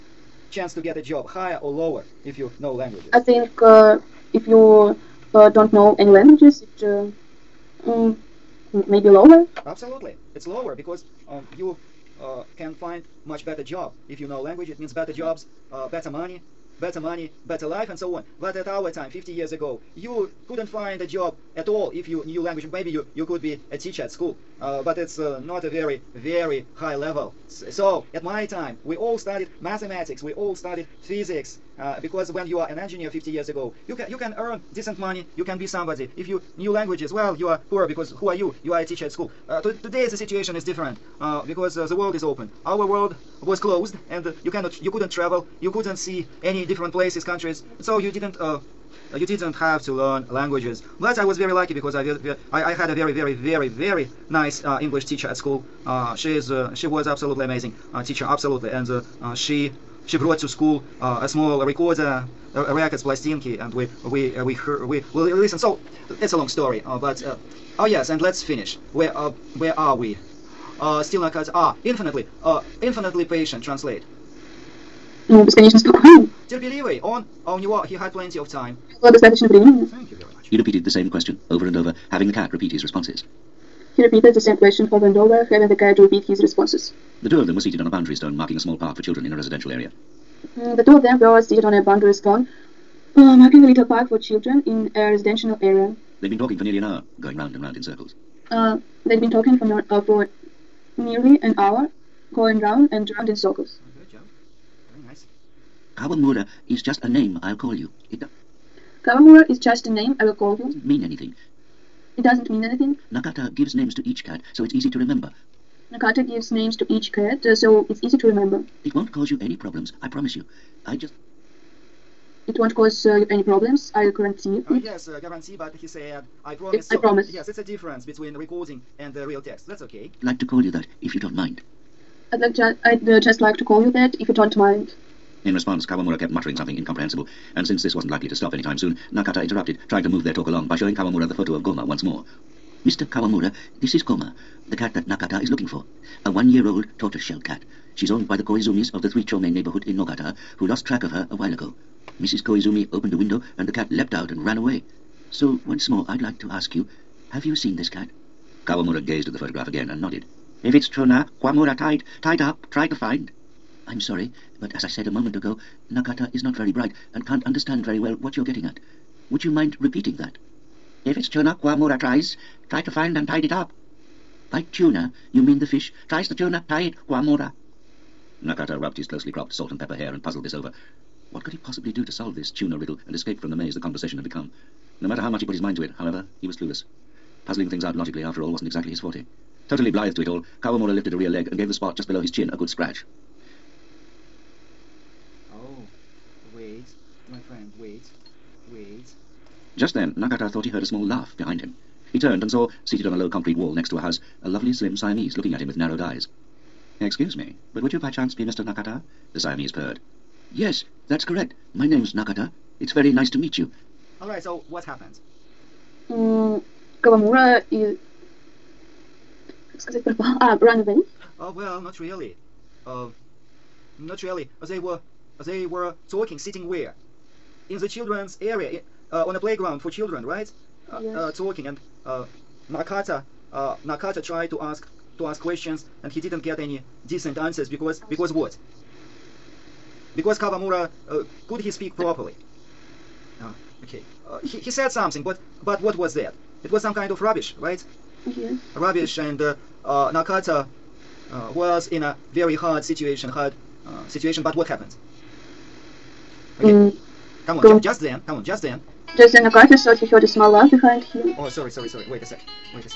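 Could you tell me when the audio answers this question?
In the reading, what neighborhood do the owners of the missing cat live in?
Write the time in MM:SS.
02:29.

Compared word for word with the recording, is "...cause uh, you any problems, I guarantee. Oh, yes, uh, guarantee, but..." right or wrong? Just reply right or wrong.
right.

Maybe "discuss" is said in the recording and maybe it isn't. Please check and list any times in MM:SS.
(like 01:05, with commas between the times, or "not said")
not said.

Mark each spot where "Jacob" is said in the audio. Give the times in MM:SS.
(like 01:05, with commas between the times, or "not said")
not said.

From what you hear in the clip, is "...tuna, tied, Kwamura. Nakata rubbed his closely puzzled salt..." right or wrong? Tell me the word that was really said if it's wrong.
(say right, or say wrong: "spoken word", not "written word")
wrong: "cropped", not "puzzled".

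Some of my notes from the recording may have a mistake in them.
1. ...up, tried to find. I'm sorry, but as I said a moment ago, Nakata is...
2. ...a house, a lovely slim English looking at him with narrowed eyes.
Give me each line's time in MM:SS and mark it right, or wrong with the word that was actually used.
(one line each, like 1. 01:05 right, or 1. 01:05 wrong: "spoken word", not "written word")
1. 02:42 right
2. 03:23 wrong: "Siamese", not "English".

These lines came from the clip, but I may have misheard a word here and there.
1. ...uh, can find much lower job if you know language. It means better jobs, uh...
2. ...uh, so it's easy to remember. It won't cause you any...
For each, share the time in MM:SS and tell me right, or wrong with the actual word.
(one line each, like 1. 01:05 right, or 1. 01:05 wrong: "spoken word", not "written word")
1. 00:12 wrong: "better", not "lower"
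2. 01:57 right.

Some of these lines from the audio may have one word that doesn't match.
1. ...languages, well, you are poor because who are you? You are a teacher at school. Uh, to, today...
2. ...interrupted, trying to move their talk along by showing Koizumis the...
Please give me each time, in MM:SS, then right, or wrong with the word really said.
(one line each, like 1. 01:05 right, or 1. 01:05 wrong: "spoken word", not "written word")
1. 00:36 right
2. 02:19 wrong: "Kawamura", not "Koizumis".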